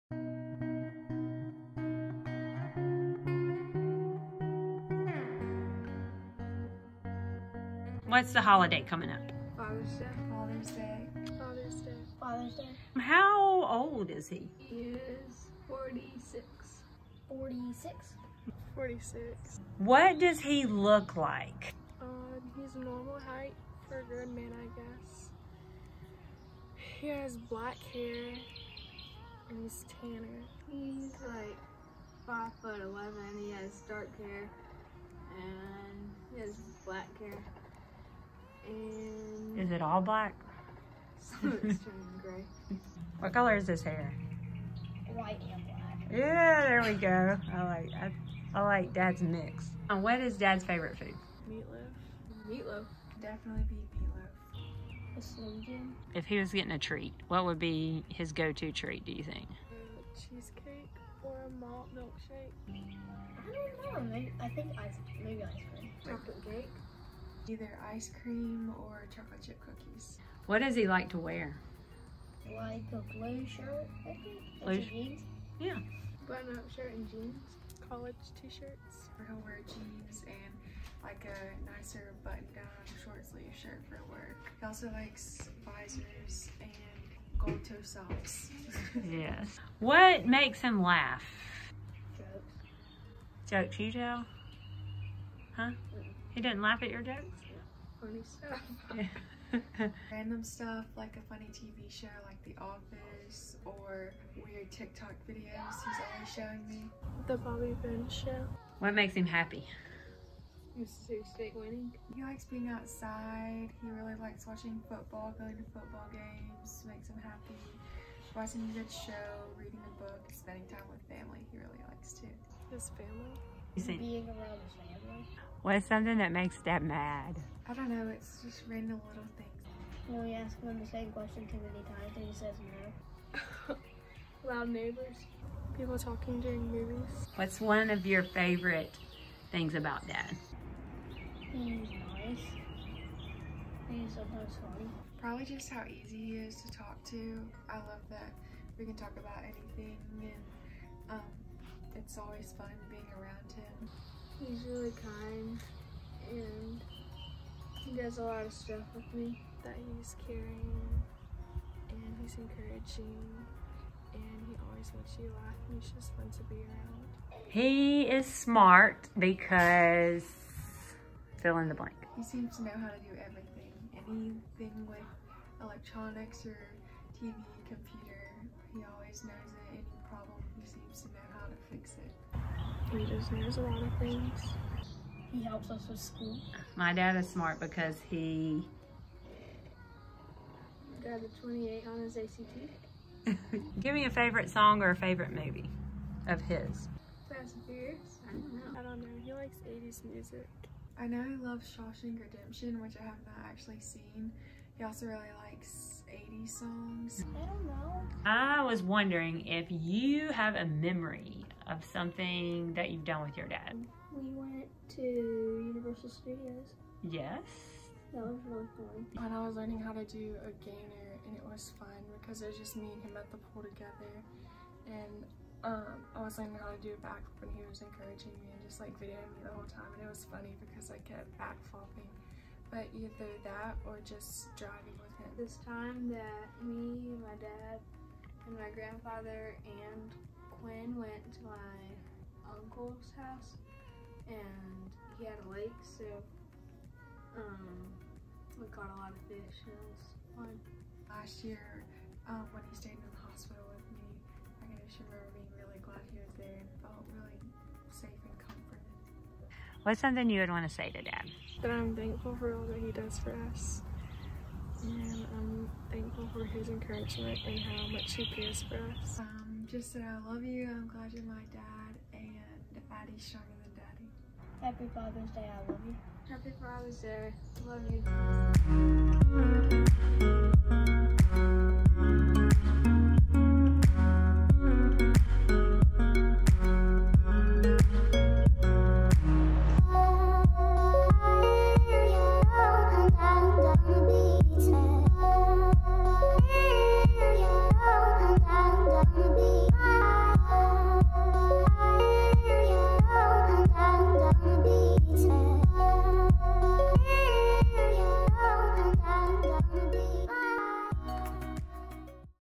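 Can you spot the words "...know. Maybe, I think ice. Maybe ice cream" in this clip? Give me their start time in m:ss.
1:04.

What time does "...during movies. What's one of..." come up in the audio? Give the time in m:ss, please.
2:16.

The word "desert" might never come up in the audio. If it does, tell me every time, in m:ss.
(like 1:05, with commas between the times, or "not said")
not said.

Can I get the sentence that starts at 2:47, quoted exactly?
He is smart because fill in the blank.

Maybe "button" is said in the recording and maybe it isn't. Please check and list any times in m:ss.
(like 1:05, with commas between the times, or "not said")
1:16, 1:22.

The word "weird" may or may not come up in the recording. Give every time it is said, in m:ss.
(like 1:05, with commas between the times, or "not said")
1:44.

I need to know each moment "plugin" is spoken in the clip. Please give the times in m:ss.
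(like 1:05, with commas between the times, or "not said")
not said.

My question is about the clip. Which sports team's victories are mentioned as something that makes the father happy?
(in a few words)
Mississippi State.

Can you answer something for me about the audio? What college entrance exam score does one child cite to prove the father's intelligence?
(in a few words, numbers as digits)
28.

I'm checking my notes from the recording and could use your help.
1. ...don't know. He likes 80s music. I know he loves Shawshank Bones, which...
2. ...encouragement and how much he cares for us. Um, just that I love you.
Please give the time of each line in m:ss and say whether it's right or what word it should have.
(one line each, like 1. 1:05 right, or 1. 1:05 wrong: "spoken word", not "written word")
1. 3:18 wrong: "Redemption", not "Bones"
2. 4:26 right.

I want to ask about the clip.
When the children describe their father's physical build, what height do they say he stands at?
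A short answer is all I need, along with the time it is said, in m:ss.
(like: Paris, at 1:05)
5 foot 11, at 0:32.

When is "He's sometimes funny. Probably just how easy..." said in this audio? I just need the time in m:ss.
2:23.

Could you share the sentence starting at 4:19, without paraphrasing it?
What's something you would want to say to dad?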